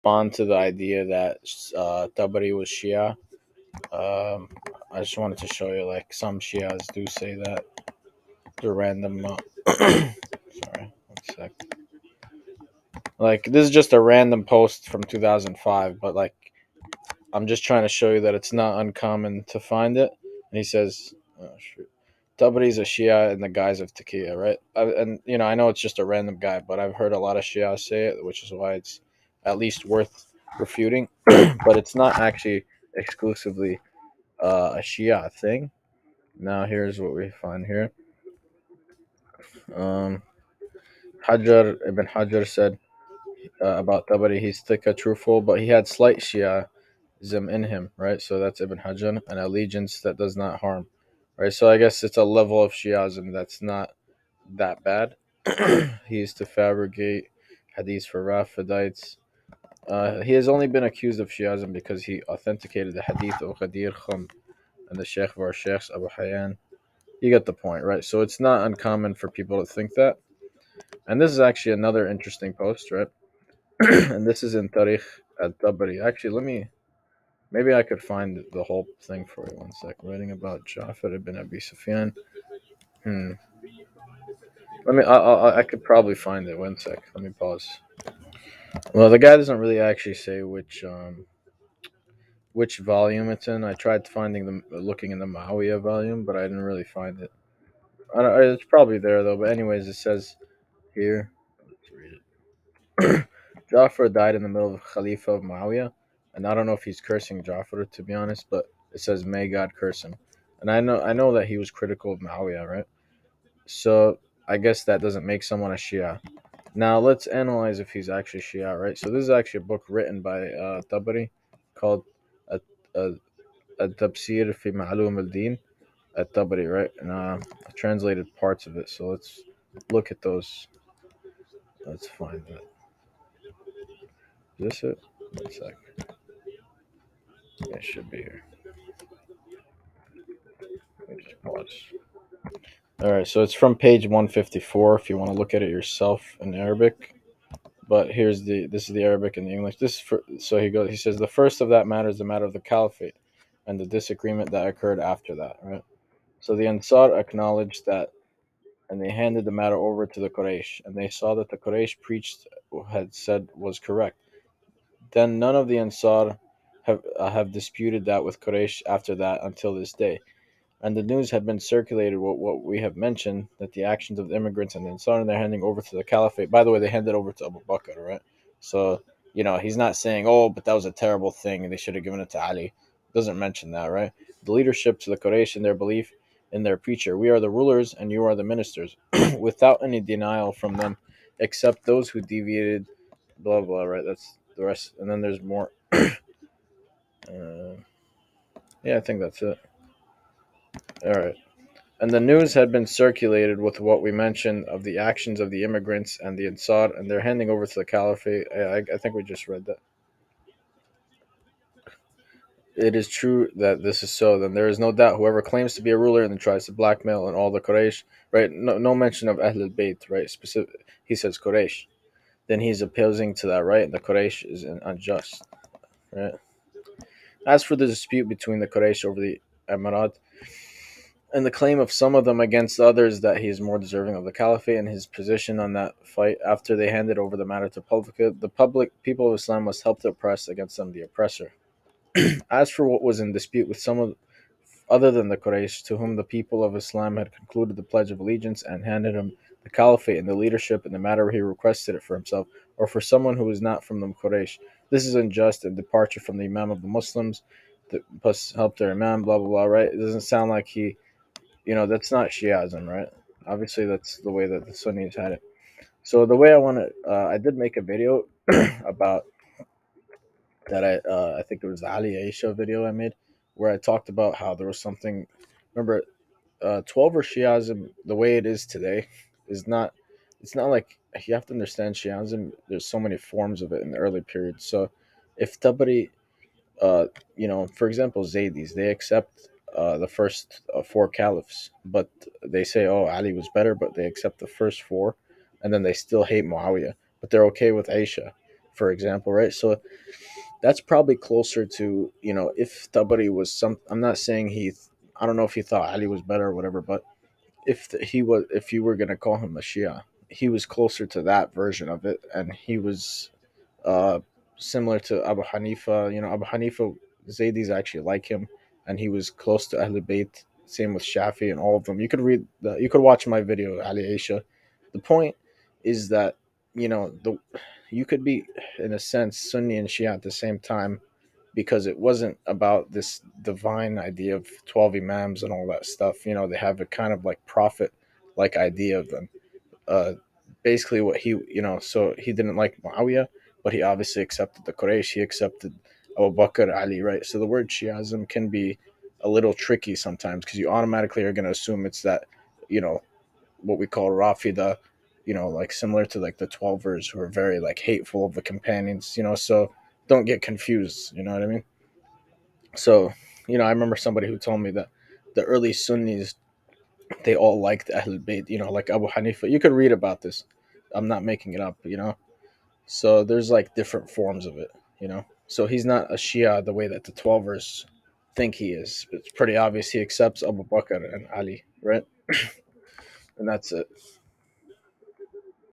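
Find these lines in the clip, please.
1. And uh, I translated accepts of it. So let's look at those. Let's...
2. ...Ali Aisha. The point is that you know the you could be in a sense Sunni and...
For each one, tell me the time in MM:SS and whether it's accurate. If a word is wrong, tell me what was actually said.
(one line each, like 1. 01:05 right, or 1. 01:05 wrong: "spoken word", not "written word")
1. 02:07 wrong: "parts", not "accepts"
2. 05:23 right.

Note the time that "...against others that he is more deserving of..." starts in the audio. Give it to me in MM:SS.
03:52.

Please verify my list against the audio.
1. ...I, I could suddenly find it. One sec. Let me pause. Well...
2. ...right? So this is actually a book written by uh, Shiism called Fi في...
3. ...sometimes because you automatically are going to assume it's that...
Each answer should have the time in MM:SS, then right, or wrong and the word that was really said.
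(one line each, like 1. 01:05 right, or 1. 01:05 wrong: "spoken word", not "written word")
1. 01:25 wrong: "probably", not "suddenly"
2. 01:58 wrong: "Tabari", not "Shiism"
3. 05:49 right.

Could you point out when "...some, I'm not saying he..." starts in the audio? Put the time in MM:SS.
05:03.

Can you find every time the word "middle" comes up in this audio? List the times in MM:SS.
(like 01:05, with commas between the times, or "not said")
01:44.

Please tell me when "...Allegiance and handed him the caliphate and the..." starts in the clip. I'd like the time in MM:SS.
04:08.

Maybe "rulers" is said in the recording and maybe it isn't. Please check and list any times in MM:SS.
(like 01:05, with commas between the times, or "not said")
03:07, 03:35.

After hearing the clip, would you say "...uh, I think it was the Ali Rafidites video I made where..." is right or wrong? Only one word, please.
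wrong.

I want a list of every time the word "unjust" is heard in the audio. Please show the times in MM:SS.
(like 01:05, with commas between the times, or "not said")
03:44, 04:15.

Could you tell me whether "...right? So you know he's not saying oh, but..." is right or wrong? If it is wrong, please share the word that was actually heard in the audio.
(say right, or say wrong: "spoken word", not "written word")
right.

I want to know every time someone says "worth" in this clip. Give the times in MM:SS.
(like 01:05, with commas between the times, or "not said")
00:29.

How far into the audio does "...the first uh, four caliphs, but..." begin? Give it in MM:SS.
04:49.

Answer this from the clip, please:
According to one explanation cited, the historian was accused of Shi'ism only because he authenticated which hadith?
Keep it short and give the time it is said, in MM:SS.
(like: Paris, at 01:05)
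Khadir Khum, at 01:03.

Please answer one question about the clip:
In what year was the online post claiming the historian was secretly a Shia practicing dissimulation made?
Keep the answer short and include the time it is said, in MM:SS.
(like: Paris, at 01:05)
2005, at 00:15.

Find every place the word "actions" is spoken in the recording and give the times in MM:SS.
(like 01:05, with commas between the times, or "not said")
02:53, 03:24.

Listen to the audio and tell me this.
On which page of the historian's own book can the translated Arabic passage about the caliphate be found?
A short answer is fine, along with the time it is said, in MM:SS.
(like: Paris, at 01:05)
154, at 02:24.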